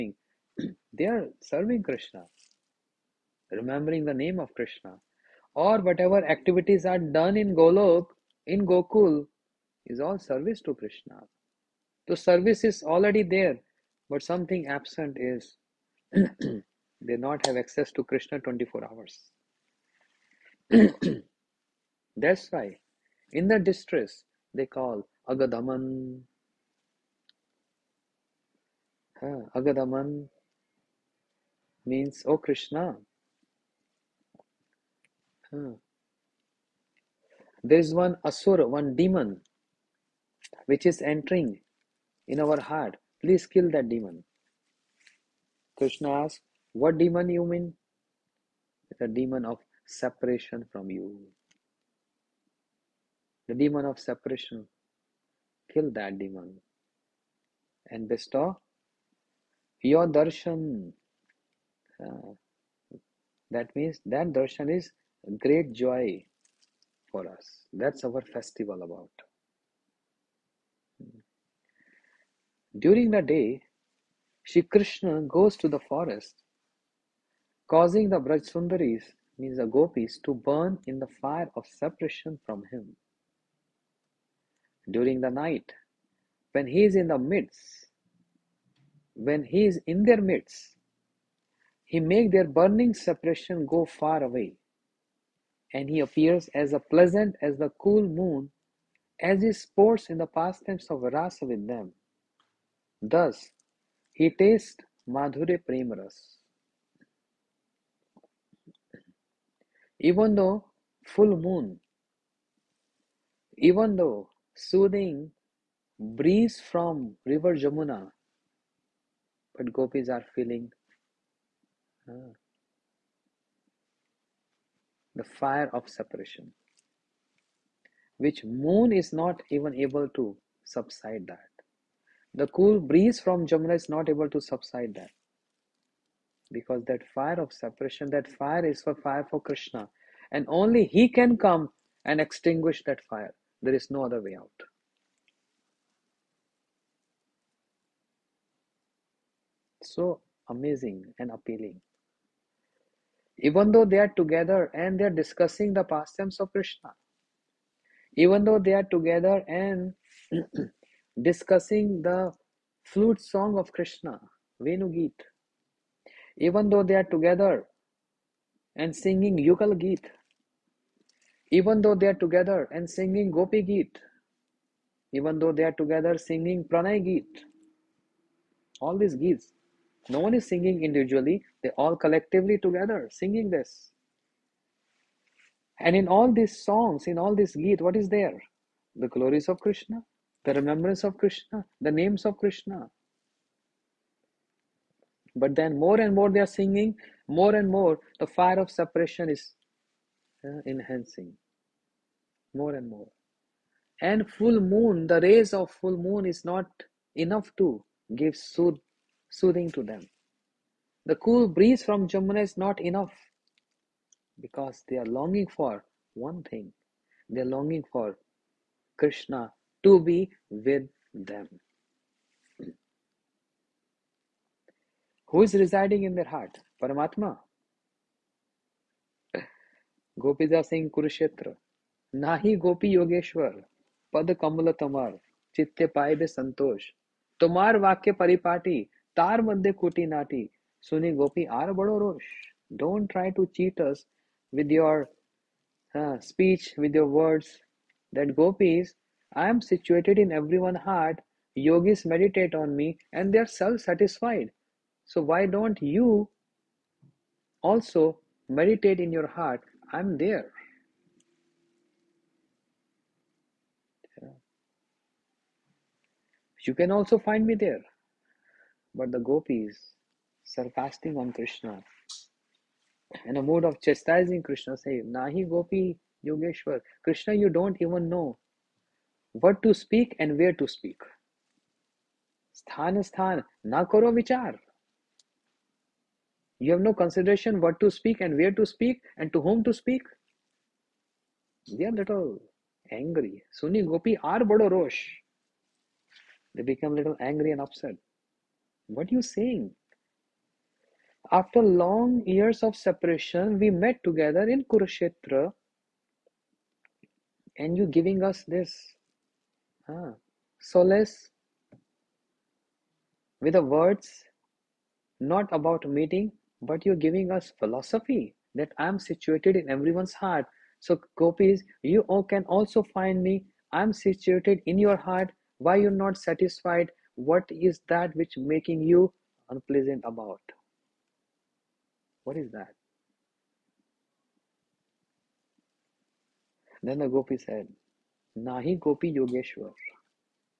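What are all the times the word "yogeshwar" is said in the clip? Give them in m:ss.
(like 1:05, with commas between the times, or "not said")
4:36, 5:39.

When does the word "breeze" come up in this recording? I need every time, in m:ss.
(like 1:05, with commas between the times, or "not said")
1:55, 2:12, 3:31.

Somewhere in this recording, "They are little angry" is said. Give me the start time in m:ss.
4:51.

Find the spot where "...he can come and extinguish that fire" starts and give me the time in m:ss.
2:20.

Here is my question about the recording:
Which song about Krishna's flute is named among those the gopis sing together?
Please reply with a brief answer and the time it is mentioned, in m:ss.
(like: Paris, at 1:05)
Venu Geet, at 2:44.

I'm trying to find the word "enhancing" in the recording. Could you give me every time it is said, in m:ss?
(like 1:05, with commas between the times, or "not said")
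3:20.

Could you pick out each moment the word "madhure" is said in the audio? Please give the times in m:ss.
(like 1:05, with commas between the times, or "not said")
1:45.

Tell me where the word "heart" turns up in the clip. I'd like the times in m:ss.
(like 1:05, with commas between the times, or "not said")
0:42, 3:46, 5:20, 5:24.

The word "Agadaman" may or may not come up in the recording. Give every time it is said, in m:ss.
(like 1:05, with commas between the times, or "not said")
0:25, 0:29.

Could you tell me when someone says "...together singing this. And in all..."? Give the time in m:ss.
3:02.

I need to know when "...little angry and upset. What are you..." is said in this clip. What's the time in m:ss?
4:56.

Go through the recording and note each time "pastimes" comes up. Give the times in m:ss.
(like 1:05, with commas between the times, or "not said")
1:40, 2:35.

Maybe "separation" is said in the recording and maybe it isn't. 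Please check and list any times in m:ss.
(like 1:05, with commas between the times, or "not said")
0:49, 0:53, 1:21, 1:32, 2:05, 2:17, 3:18, 5:02.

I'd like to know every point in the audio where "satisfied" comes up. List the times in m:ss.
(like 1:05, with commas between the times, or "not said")
5:26.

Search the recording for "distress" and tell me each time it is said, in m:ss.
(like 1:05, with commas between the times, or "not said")
0:23.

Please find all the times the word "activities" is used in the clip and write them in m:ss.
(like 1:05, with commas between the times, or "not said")
0:06.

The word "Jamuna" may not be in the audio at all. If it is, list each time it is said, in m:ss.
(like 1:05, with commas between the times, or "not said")
1:57, 2:13, 3:32.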